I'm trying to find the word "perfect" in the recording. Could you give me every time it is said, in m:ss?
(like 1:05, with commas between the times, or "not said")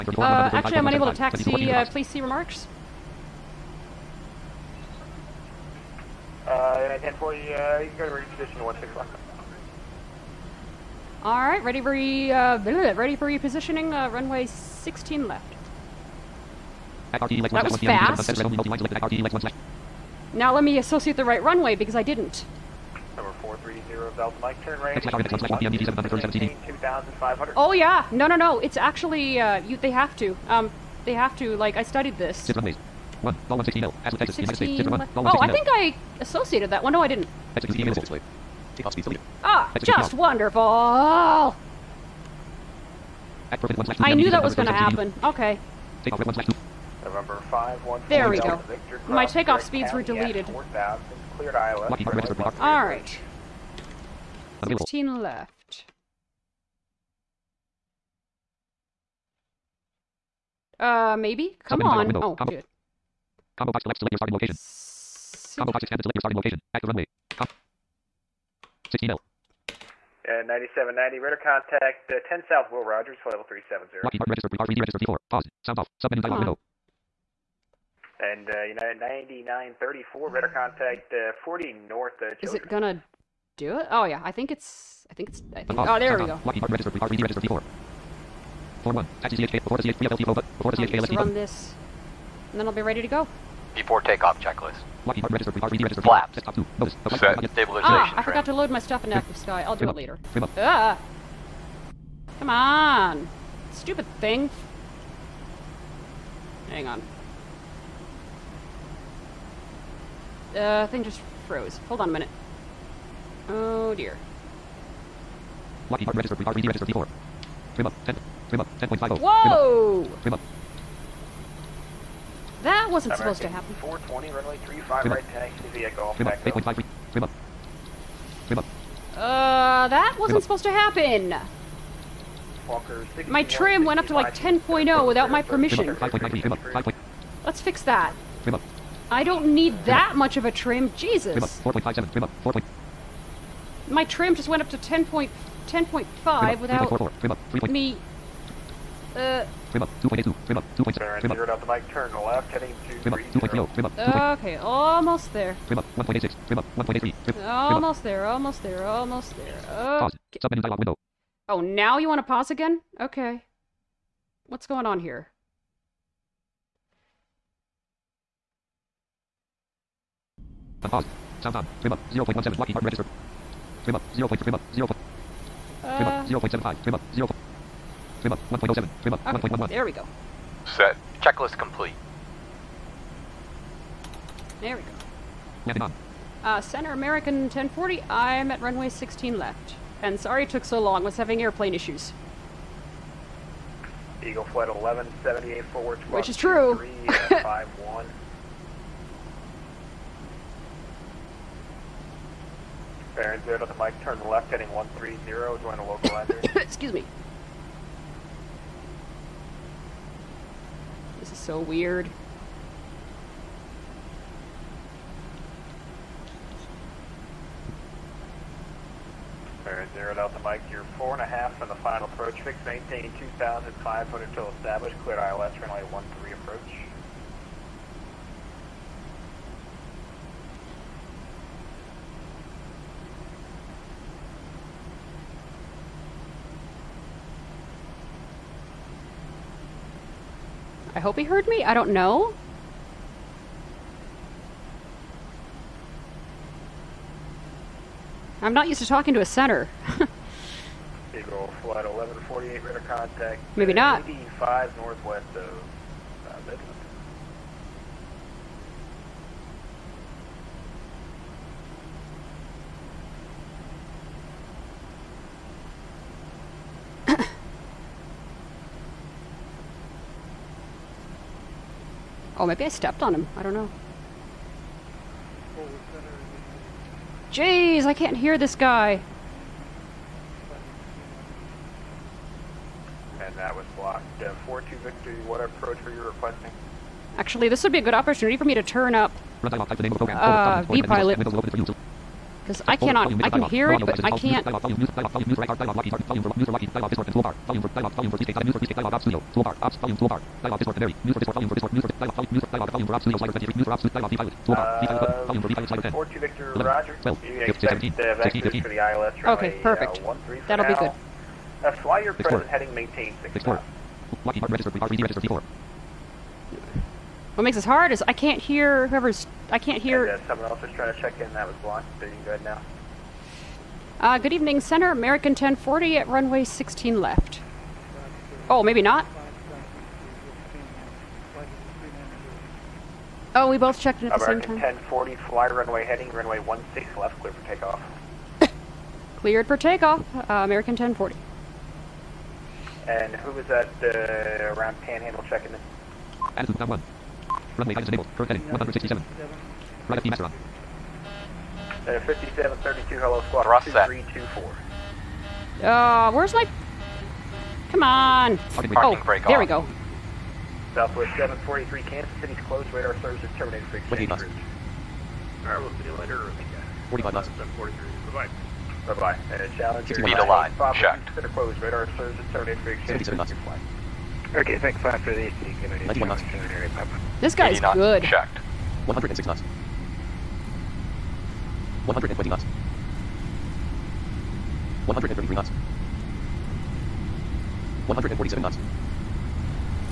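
5:09.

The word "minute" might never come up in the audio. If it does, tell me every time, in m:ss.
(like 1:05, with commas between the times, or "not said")
1:52.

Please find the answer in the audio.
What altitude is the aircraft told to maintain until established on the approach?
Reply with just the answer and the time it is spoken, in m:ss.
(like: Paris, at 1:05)
2,500, at 3:43.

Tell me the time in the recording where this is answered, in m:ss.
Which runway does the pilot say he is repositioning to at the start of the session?
0:08.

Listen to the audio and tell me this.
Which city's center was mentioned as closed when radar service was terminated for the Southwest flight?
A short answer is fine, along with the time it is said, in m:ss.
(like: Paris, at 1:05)
Kansas City, at 6:01.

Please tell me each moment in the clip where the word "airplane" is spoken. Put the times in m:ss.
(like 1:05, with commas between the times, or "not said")
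3:11.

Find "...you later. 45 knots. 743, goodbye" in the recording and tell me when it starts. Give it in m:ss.
6:05.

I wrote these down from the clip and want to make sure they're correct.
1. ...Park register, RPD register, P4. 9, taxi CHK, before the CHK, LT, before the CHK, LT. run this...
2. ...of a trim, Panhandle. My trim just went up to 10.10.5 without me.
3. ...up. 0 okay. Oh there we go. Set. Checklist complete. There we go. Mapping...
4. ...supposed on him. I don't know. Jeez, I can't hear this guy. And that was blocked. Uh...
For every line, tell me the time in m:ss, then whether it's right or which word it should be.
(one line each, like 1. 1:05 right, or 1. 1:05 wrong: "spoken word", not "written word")
1. 1:26 wrong: "1", not "9"
2. 2:20 wrong: "Jesus", not "Panhandle"
3. 2:56 right
4. 4:32 wrong: "stepped", not "supposed".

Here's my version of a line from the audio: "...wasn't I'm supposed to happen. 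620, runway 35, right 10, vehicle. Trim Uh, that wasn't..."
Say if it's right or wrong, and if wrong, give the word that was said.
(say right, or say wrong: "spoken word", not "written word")
wrong: "420", not "620".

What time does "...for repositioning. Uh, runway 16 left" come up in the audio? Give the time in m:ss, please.
0:13.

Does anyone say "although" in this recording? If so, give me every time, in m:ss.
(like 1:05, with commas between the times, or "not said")
not said.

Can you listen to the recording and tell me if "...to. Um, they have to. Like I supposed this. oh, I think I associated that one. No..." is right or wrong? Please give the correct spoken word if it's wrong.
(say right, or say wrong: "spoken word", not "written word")
wrong: "studied", not "supposed".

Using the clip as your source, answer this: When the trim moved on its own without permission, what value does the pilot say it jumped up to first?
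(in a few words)
10.0.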